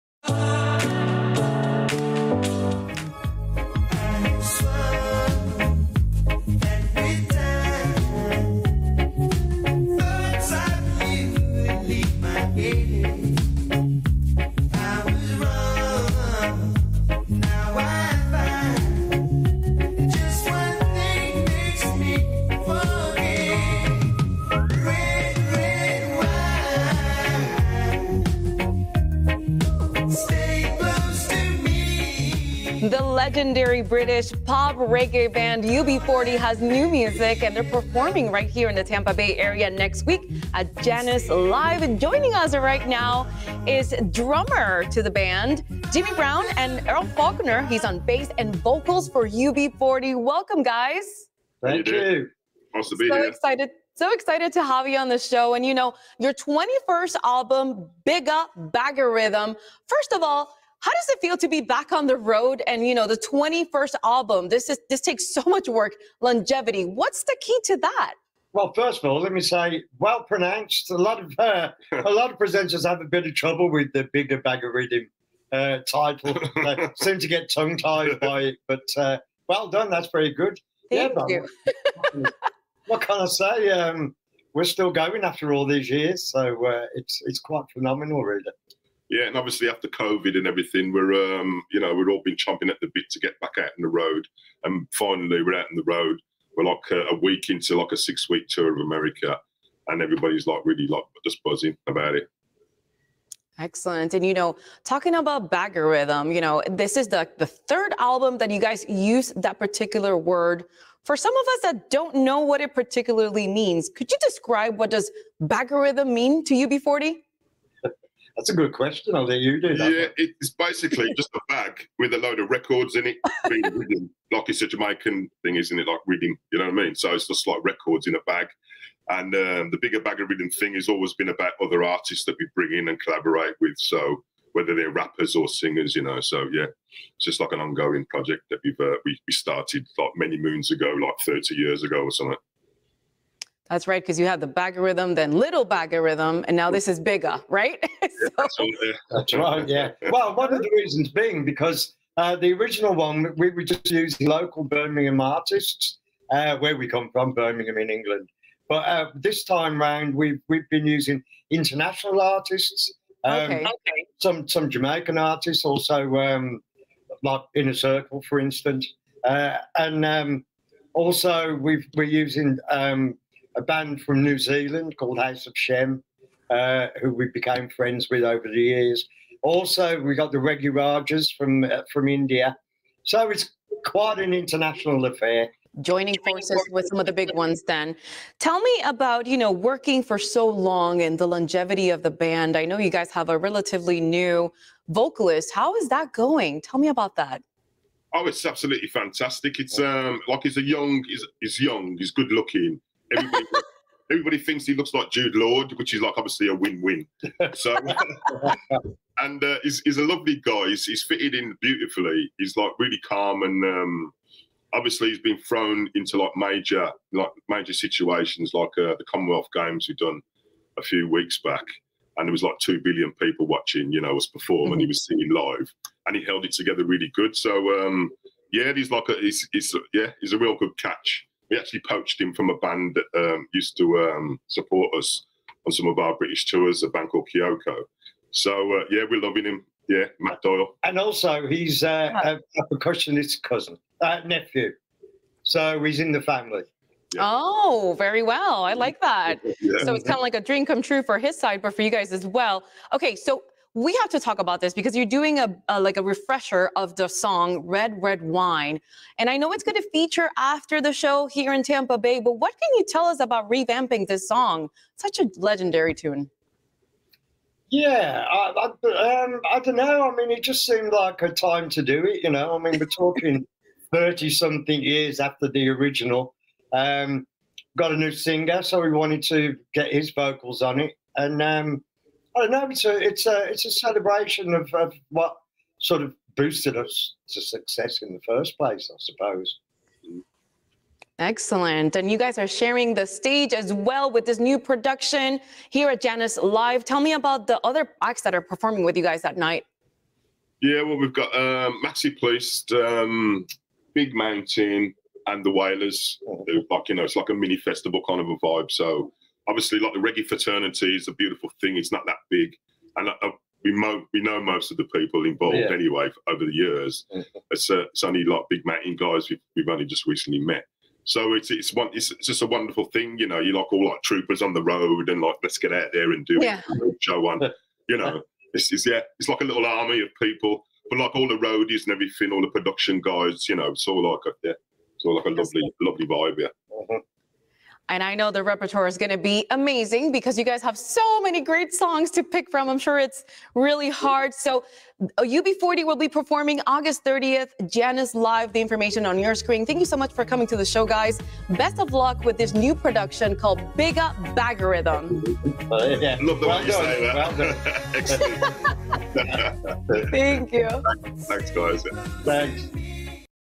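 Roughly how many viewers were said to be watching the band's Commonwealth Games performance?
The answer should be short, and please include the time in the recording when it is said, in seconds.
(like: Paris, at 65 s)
2 billion, at 222 s.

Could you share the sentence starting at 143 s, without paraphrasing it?
That's right, because you have the Baggariddim, then little Baggariddim, and now this is bigger, right?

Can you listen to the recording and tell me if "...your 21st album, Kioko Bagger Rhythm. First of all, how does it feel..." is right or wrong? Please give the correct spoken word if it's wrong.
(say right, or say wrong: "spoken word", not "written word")
wrong: "Bigger", not "Kioko".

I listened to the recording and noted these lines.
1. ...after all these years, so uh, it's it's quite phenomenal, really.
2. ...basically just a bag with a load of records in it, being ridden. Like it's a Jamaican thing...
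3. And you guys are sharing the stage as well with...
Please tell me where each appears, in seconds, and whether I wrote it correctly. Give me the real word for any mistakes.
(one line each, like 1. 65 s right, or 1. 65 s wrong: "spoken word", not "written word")
1. 85 s right
2. 120 s right
3. 291 s right.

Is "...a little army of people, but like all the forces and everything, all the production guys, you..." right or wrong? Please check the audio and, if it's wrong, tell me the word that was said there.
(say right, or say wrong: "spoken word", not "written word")
wrong: "roadies", not "forces".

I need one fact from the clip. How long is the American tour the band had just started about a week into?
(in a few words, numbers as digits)
6 weeks.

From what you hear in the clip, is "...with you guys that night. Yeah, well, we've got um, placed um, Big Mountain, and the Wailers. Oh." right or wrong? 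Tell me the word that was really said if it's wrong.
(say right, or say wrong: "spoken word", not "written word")
right.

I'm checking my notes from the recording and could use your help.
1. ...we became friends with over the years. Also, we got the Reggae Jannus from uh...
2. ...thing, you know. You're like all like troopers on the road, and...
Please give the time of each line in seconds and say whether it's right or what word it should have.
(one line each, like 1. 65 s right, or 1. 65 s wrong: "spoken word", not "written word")
1. 177 s wrong: "Rajas", not "Jannus"
2. 322 s right.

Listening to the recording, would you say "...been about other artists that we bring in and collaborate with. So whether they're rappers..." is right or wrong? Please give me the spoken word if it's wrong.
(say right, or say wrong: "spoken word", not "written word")
right.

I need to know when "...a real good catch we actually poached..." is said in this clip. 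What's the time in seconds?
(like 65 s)
230 s.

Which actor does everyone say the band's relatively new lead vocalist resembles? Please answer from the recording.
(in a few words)
Jude Law.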